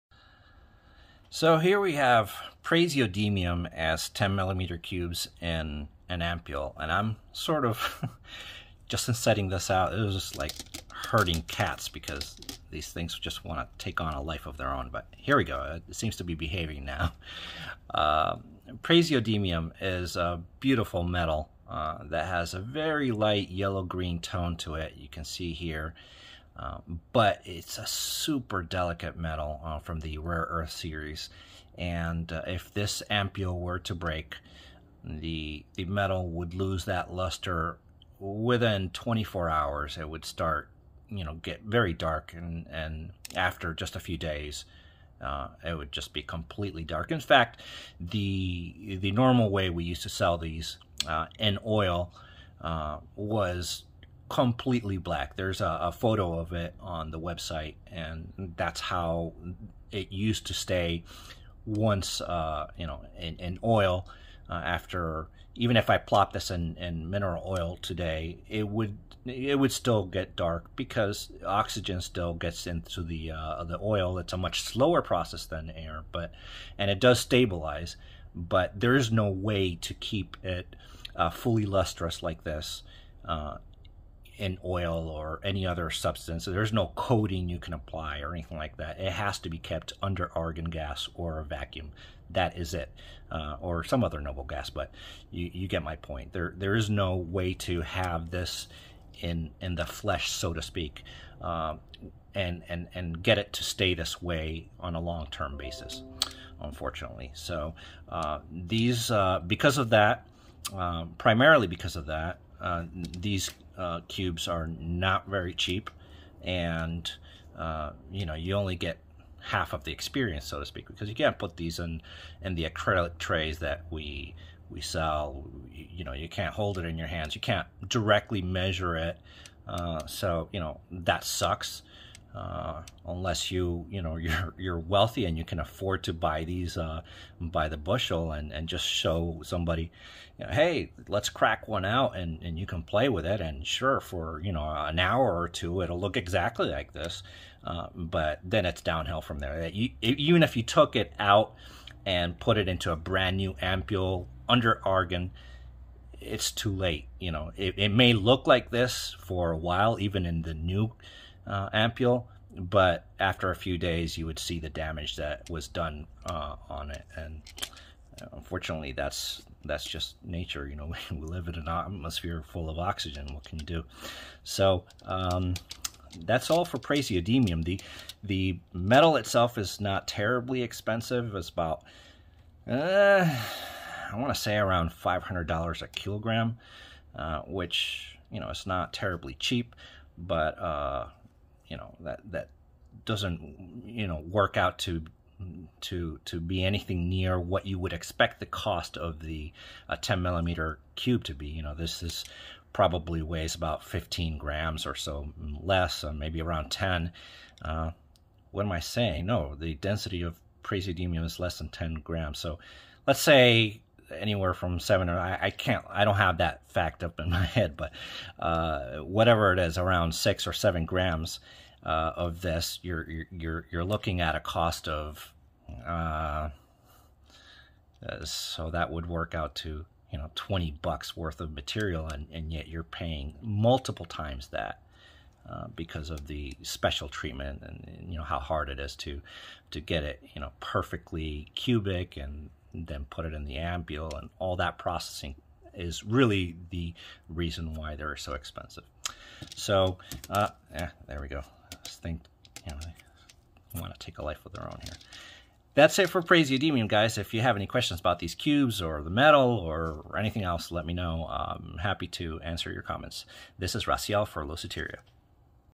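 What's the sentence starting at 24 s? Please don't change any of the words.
You can see here um, but it's a super delicate metal uh, from the rare earth series.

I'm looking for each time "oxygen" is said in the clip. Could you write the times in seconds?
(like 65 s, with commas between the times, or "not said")
71 s, 172 s.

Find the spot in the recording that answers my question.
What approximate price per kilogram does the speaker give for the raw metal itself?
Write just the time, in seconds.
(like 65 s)
184 s.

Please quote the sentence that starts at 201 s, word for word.
You know, this is probably weighs about 15 grams or so mm, less, or uh, maybe around 10.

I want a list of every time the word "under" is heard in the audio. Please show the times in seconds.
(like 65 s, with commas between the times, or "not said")
90 s, 154 s.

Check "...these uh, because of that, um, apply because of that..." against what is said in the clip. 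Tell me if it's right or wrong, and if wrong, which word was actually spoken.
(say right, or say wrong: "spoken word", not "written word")
wrong: "primarily", not "apply".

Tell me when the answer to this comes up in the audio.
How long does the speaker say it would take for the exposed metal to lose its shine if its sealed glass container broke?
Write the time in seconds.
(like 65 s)
38 s.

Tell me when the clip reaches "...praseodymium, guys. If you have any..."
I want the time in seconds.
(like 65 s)
256 s.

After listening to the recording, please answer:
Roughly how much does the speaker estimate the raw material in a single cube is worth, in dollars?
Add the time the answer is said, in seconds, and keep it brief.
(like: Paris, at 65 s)
$20, at 230 s.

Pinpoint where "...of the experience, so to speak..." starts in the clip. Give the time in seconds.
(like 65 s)
119 s.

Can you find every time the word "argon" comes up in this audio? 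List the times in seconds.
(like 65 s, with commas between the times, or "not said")
90 s, 154 s.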